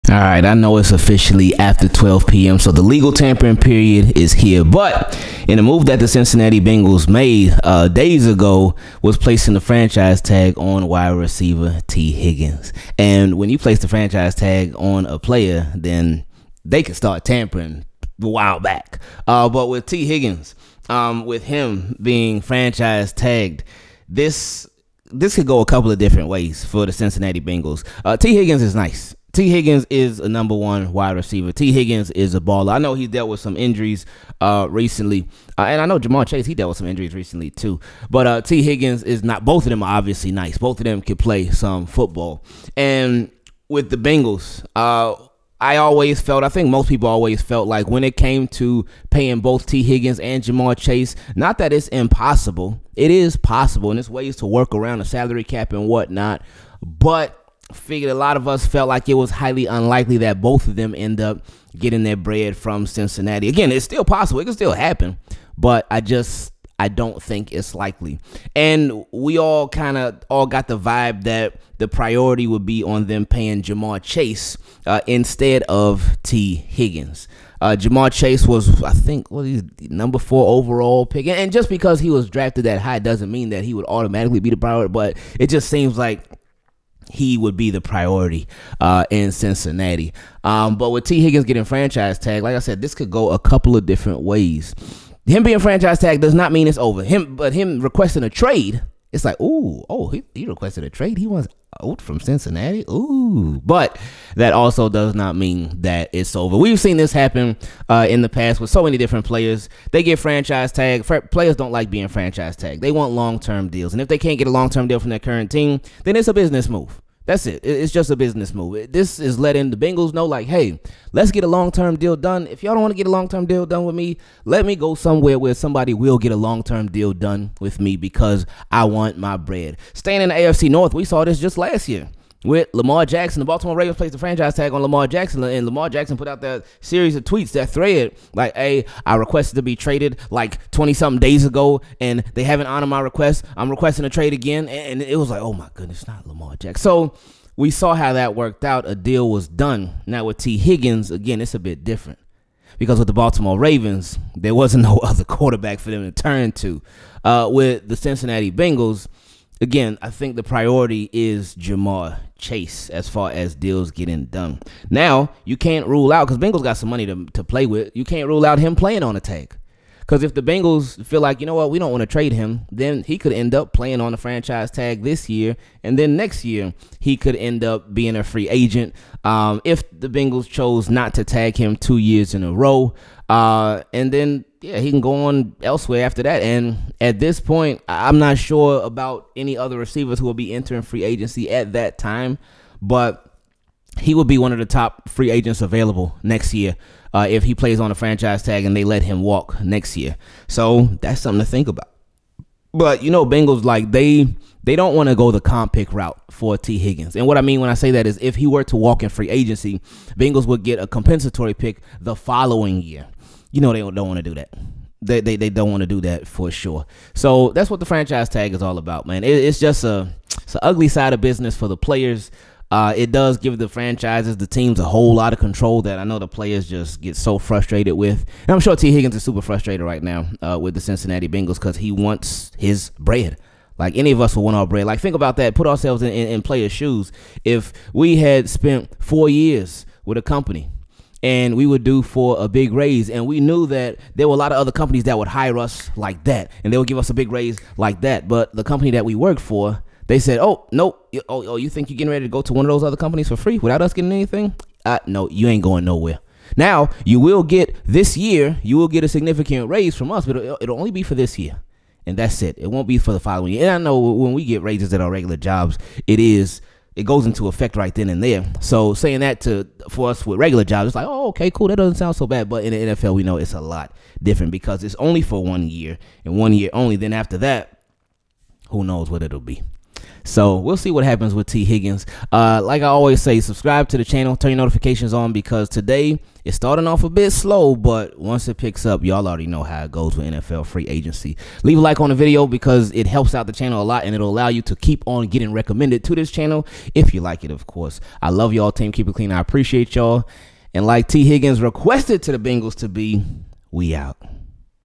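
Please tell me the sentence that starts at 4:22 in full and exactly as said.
It won't be for the following year.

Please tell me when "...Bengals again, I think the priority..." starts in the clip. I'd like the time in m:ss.
2:38.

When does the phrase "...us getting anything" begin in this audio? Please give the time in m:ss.
4:13.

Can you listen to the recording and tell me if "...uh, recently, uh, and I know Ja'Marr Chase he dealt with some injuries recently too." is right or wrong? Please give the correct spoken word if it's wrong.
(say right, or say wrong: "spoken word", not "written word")
right.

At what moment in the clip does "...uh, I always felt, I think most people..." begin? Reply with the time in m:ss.
0:44.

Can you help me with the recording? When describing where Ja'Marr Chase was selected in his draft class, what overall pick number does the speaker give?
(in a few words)
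4.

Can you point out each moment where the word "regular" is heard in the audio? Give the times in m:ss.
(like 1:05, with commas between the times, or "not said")
4:25, 4:30.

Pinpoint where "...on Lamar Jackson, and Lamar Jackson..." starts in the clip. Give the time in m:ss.
2:14.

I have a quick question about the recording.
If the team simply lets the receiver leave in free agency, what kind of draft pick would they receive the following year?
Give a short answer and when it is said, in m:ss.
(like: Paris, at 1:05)
A compensatory pick, at 3:30.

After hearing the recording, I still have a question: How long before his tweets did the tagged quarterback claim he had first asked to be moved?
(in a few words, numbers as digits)
20 something days.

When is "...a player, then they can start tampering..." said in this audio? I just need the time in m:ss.
0:15.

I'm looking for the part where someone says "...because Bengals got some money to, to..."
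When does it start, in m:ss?
2:46.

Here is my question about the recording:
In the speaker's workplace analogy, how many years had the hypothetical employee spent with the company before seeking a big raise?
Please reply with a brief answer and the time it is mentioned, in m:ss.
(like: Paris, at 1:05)
4, at 3:59.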